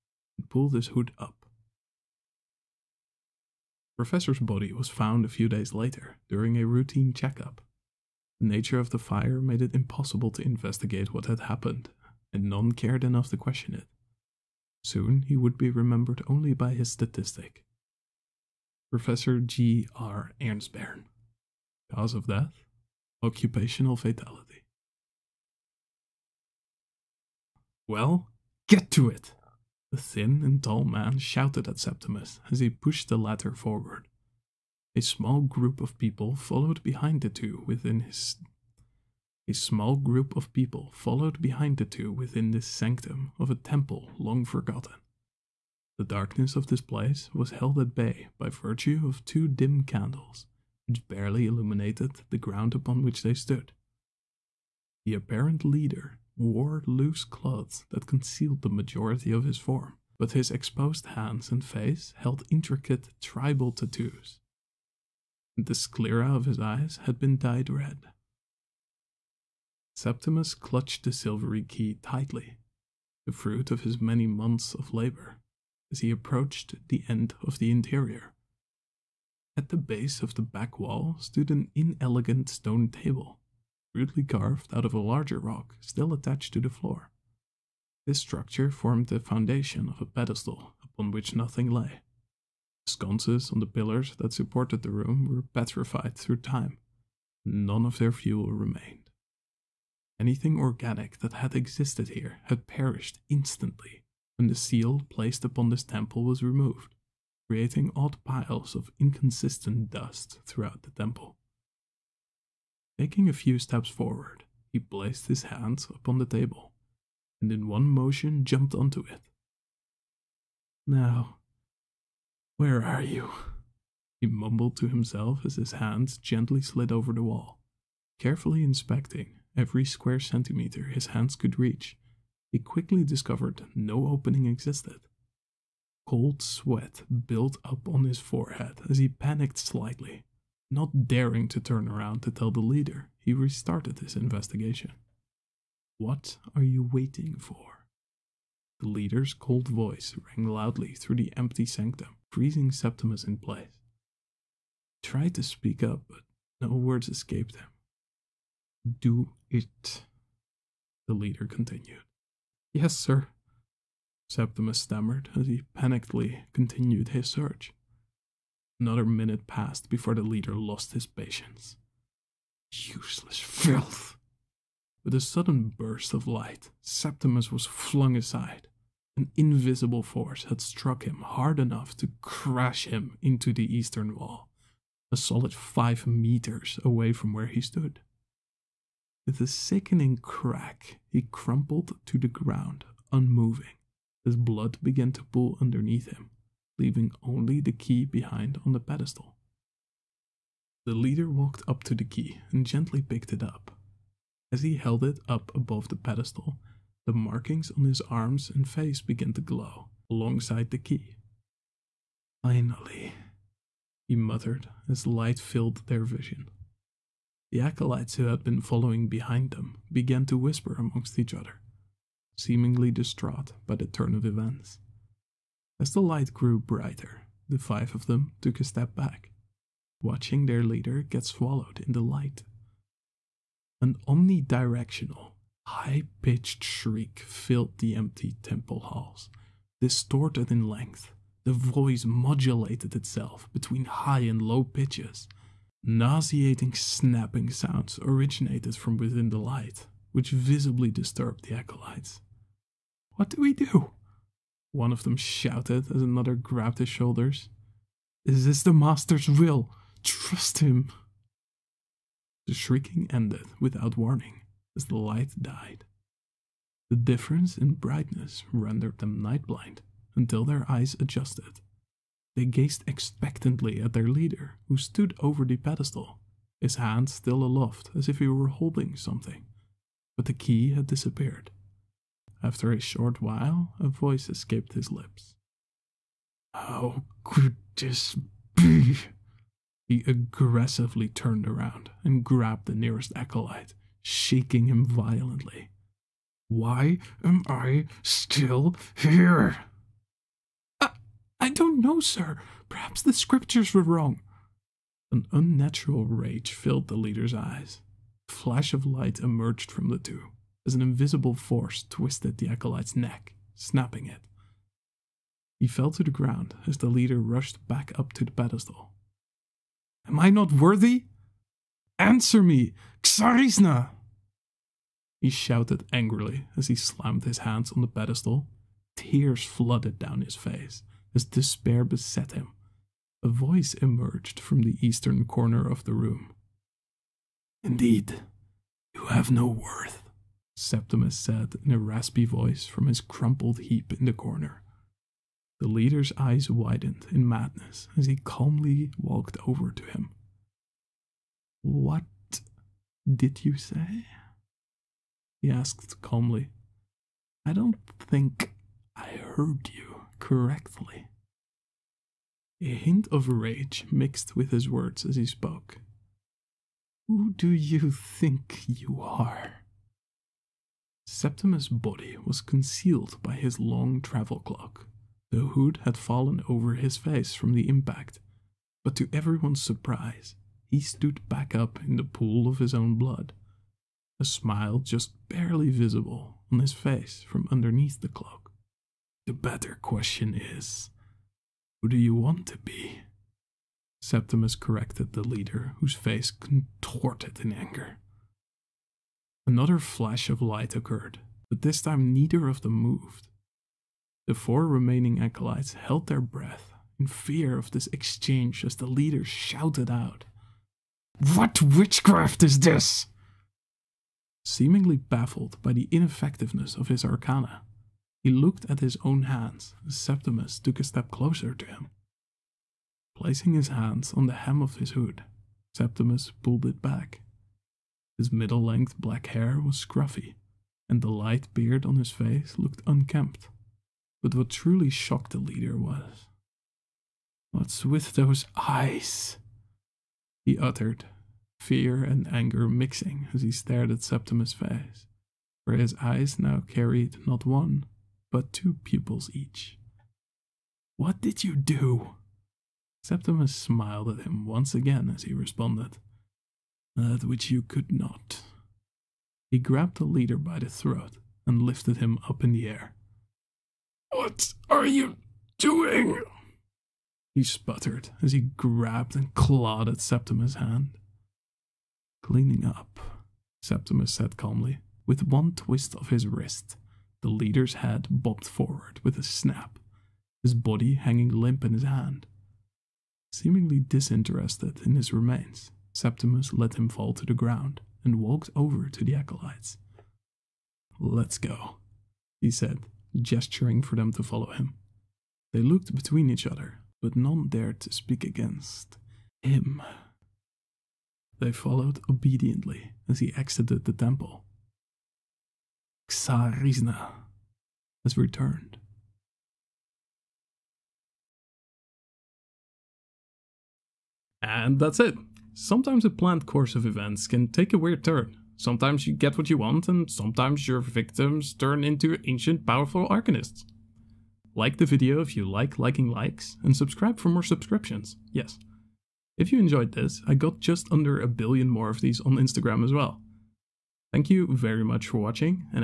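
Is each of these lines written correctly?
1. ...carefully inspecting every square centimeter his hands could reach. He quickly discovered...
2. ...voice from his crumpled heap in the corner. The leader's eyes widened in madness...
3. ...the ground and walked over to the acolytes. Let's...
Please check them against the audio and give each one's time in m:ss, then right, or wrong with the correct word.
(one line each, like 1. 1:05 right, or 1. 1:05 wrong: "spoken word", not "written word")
1. 2:08 right
2. 5:42 right
3. 8:07 right.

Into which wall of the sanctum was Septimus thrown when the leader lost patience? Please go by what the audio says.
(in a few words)
Eastern wall.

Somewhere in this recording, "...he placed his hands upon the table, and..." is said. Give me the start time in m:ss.
1:54.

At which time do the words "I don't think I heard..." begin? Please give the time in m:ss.
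5:57.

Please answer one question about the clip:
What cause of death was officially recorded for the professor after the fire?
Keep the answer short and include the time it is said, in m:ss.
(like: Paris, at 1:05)
Occupational fatality, at 0:23.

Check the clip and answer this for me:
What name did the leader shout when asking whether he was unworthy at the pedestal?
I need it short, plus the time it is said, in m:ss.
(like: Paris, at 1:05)
Xarisna, at 5:23.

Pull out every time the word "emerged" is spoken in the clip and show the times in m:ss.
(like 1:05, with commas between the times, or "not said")
5:09, 5:33.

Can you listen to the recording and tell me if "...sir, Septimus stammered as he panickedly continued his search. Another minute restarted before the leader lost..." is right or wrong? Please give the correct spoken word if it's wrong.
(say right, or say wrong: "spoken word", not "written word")
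wrong: "passed", not "restarted".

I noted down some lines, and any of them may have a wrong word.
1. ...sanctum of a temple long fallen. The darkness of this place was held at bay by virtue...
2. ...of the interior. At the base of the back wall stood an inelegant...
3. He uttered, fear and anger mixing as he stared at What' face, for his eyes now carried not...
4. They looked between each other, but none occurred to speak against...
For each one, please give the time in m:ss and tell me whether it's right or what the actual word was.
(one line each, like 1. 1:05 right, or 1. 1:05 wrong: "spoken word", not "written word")
1. 0:42 wrong: "forgotten", not "fallen"
2. 1:17 right
3. 7:20 wrong: "Septimus", not "What"
4. 8:15 wrong: "dared", not "occurred".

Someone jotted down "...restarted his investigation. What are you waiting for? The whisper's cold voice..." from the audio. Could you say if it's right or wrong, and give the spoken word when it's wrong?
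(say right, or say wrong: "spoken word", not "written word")
wrong: "leader", not "whisper".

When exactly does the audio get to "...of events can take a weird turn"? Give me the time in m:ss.
8:36.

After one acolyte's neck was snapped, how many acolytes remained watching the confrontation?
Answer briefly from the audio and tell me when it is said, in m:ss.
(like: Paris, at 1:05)
4, at 6:44.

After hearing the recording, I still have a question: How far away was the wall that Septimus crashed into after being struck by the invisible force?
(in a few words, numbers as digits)
5 meters.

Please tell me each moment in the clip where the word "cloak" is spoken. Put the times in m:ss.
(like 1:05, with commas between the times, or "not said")
6:14, 6:28.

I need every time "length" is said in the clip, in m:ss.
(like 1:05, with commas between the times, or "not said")
4:00, 7:08.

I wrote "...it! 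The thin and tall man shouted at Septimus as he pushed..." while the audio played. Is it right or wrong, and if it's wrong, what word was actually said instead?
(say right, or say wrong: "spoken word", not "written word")
right.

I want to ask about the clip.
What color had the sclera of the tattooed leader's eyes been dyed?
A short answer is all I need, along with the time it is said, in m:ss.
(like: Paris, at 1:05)
Red, at 1:07.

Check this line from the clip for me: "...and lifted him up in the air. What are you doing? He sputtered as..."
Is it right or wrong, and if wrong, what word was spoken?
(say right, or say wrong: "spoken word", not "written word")
right.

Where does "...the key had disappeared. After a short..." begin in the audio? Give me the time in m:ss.
4:40.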